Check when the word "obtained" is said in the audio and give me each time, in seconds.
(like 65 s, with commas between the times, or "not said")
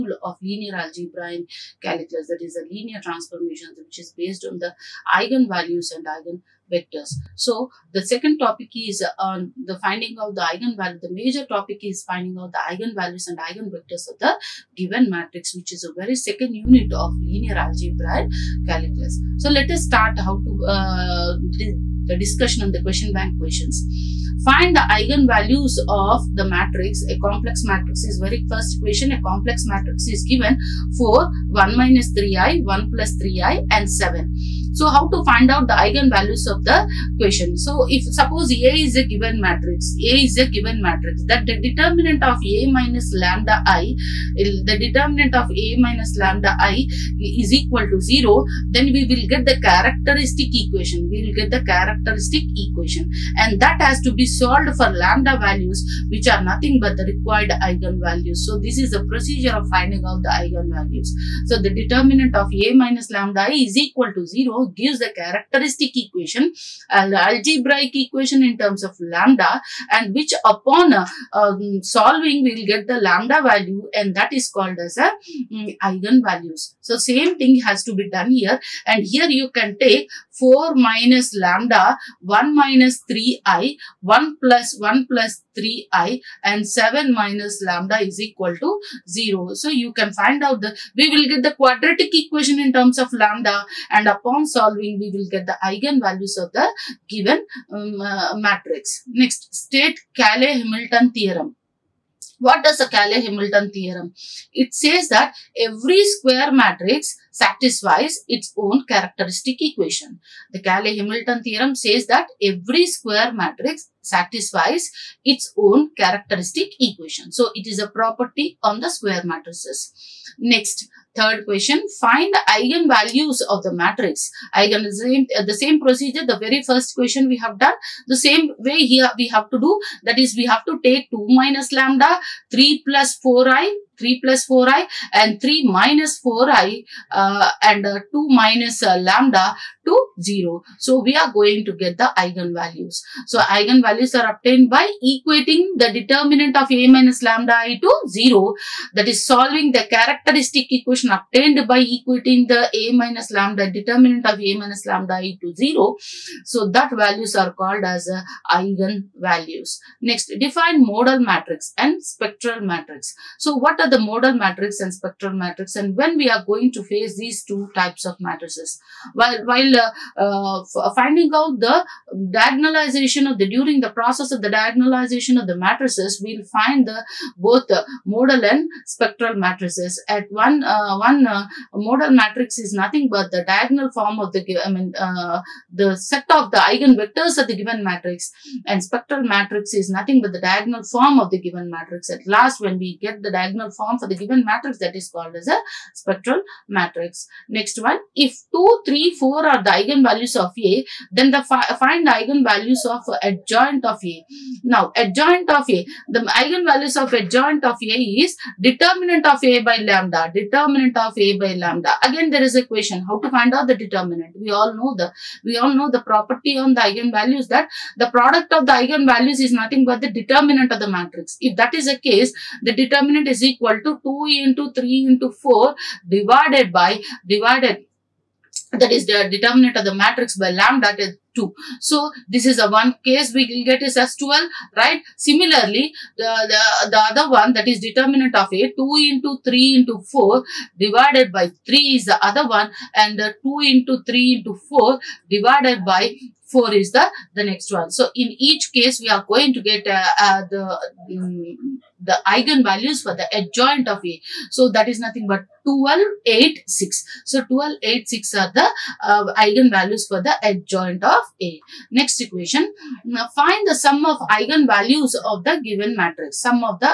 144 s, 151 s.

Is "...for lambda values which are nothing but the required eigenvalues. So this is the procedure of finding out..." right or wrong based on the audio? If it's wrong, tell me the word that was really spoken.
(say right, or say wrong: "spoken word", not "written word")
right.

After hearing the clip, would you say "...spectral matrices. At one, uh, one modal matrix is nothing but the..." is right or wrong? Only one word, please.
right.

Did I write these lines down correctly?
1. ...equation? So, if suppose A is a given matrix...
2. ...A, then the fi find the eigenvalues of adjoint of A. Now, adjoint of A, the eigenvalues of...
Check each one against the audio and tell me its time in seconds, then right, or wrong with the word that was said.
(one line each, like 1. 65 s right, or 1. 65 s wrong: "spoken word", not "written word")
1. 37 s right
2. 200 s right.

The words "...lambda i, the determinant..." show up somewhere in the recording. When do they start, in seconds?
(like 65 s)
43 s.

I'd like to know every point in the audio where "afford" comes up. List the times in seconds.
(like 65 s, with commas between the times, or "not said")
not said.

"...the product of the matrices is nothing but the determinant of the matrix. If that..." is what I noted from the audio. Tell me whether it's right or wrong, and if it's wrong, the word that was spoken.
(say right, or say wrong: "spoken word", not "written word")
wrong: "eigenvalues", not "matrices".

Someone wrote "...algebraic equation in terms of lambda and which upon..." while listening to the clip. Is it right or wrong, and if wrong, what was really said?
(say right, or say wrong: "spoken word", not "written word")
right.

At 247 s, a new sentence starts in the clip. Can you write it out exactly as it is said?
So in each case we are going to get uh, uh, the um, the eigenvalues for the adjoint of A.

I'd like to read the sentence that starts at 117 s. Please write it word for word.
So, it is a property on the square matrices.